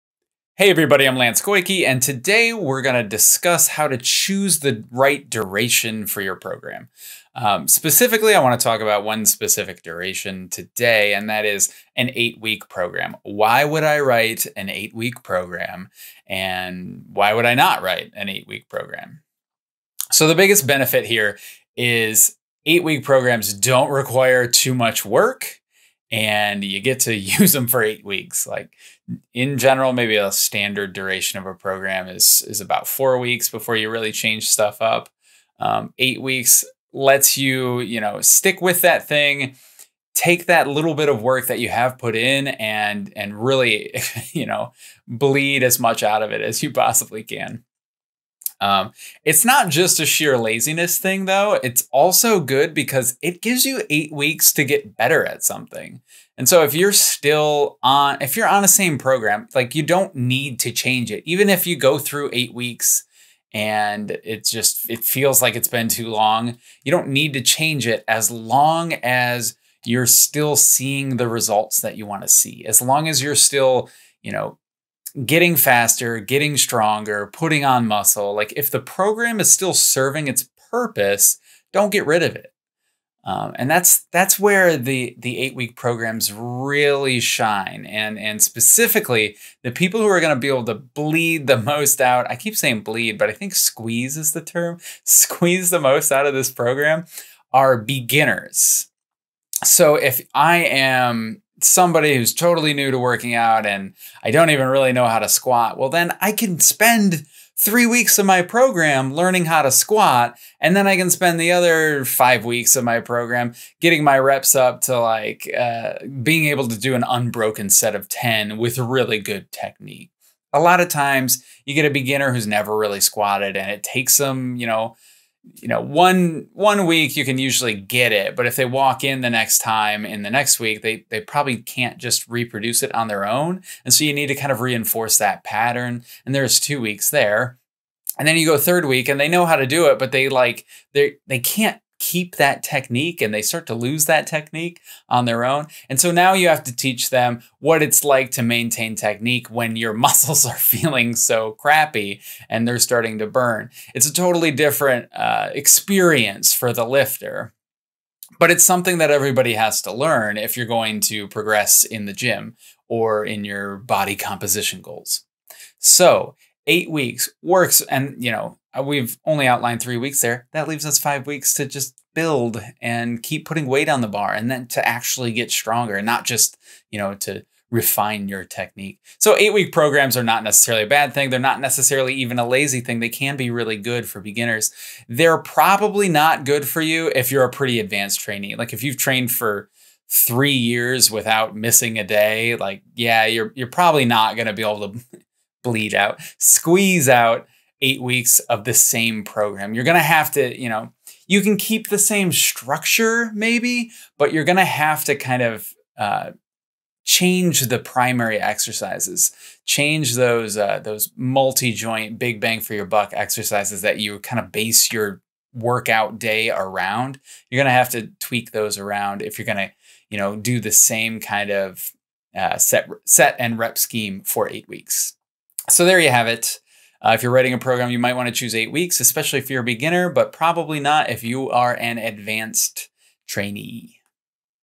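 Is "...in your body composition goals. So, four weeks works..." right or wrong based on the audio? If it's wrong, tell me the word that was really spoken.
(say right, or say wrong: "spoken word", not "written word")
wrong: "eight", not "four".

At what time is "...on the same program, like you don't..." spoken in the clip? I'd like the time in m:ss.
0:58.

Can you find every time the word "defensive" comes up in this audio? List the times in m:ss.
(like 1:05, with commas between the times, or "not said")
not said.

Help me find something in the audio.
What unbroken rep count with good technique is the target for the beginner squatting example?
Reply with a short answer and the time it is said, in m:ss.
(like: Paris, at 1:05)
10, at 1:58.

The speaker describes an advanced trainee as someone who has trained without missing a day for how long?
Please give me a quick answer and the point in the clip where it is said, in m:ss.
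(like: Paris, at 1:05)
3 years, at 3:10.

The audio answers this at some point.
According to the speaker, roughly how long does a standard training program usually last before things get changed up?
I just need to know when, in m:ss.
0:32.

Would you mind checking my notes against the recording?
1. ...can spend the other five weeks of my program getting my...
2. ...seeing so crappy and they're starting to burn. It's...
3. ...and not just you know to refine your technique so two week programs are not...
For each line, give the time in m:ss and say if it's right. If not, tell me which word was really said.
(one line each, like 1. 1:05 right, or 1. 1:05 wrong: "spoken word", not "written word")
1. 1:50 right
2. 2:30 wrong: "feeling", not "seeing"
3. 2:55 wrong: "eight", not "two".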